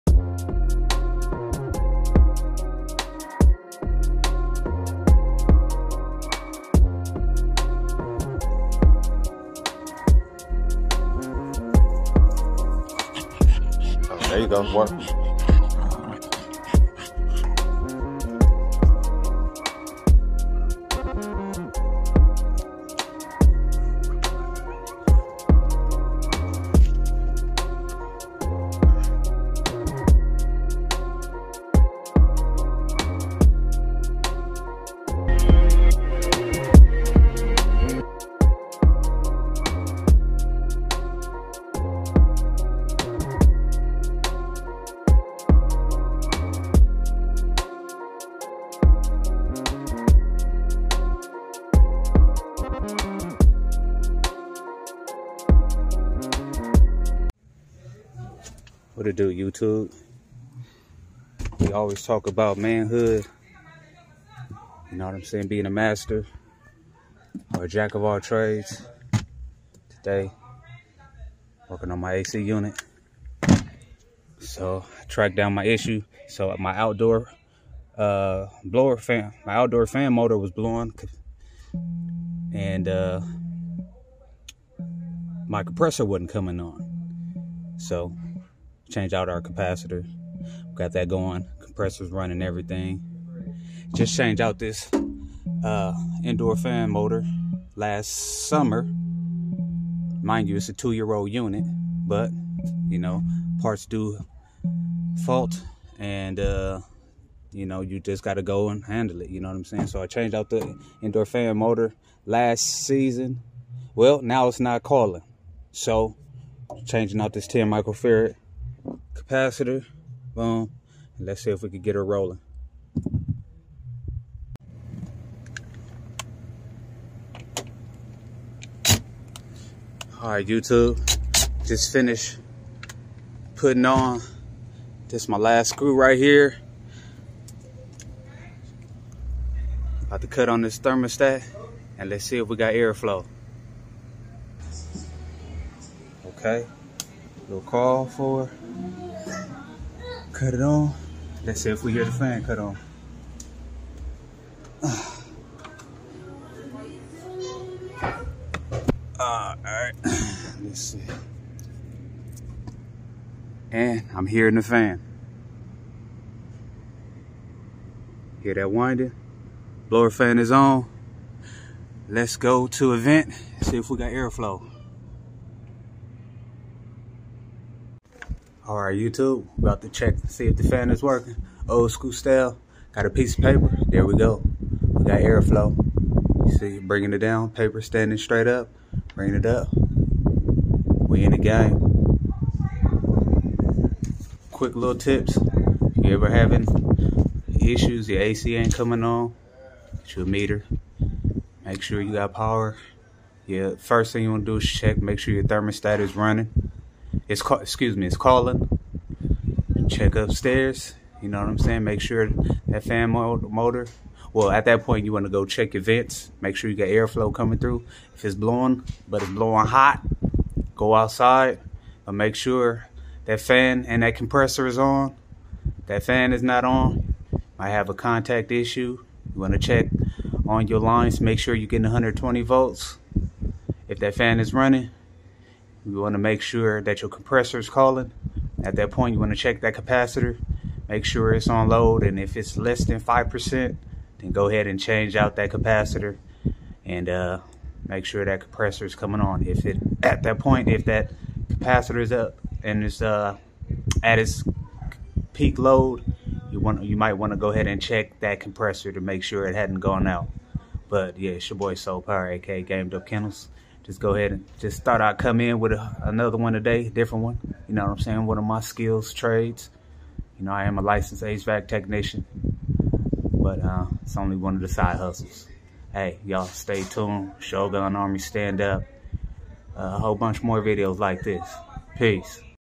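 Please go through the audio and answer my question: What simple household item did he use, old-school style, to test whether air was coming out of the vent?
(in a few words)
A piece of paper.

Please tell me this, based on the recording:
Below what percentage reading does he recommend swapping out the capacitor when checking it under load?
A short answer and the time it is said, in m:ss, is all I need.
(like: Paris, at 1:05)
5%, at 4:02.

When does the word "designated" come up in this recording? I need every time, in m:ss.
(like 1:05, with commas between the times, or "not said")
not said.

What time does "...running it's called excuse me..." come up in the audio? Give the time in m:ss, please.
3:26.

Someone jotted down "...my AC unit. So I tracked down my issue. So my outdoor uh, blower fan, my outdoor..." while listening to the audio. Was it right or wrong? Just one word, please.
right.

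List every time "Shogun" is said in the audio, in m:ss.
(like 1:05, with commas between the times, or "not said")
4:37.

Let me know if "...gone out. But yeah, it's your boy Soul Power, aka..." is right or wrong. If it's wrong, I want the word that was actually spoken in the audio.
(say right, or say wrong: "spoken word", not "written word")
right.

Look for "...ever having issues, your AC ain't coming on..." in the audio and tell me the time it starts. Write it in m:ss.
3:16.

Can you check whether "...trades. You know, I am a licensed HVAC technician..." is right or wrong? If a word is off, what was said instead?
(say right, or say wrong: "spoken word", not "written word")
right.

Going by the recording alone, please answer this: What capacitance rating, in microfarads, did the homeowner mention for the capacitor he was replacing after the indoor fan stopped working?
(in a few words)
10 microfarad.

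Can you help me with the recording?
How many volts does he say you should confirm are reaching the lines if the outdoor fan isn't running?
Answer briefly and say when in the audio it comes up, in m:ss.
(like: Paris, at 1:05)
120 volts, at 3:51.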